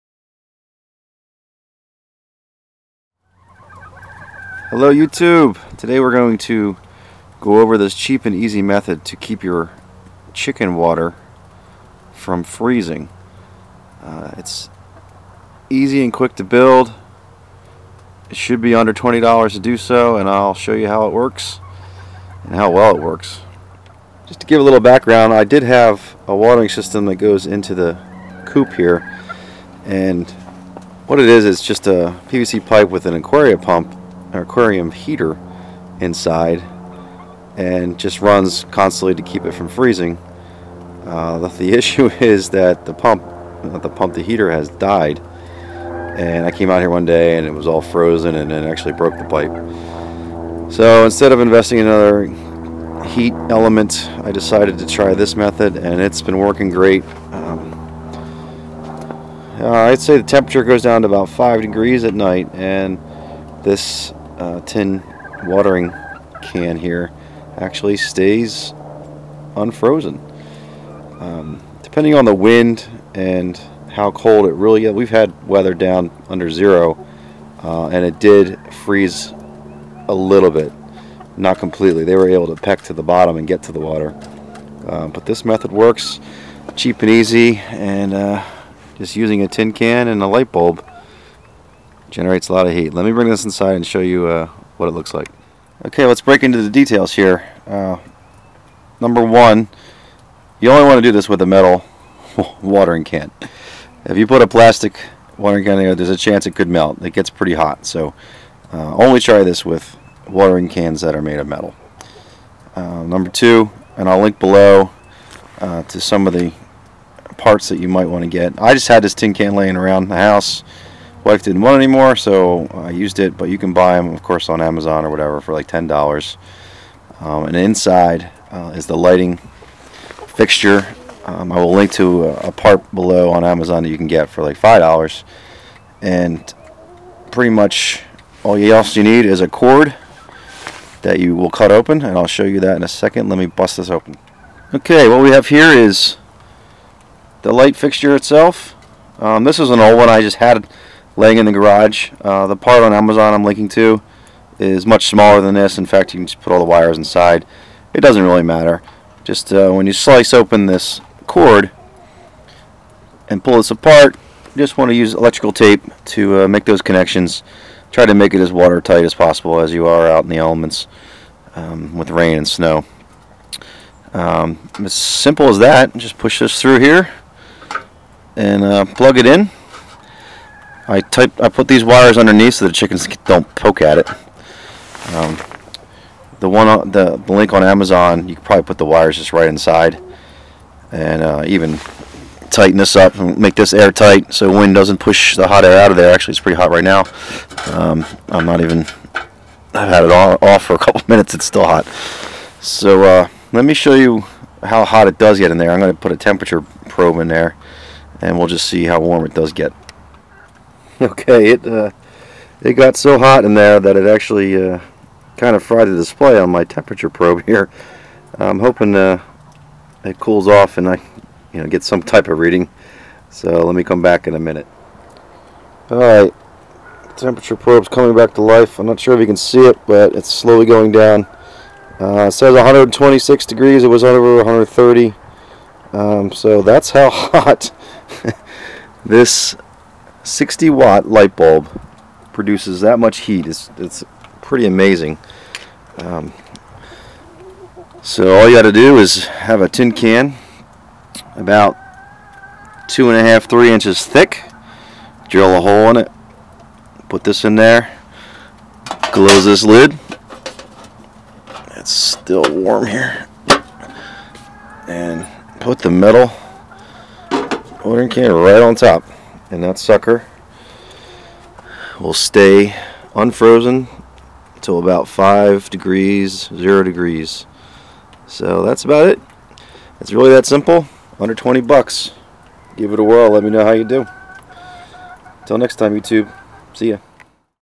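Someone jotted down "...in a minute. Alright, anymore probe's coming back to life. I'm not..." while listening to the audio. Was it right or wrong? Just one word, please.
wrong.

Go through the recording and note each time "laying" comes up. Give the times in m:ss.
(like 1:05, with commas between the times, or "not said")
1:59, 2:31.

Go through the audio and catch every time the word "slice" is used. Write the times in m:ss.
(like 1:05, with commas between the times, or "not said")
2:39.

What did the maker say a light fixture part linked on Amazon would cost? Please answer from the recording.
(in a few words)
5 dollars.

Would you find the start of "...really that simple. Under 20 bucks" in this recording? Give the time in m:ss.
4:40.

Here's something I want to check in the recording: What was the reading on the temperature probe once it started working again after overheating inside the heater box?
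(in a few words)
126 degrees.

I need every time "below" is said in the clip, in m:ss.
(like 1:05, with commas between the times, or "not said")
1:54, 2:12.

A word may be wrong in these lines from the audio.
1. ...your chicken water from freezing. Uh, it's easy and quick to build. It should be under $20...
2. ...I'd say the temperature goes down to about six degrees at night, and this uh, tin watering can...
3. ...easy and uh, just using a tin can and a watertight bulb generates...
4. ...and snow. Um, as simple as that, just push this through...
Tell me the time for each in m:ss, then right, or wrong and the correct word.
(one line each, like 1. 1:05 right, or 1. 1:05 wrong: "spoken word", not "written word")
1. 0:09 right
2. 0:59 wrong: "five", not "six"
3. 1:27 wrong: "light", not "watertight"
4. 2:52 right.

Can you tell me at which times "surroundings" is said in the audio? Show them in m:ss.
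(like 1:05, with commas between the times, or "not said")
not said.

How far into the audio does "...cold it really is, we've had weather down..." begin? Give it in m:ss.
1:14.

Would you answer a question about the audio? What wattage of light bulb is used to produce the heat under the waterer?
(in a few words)
60 watt.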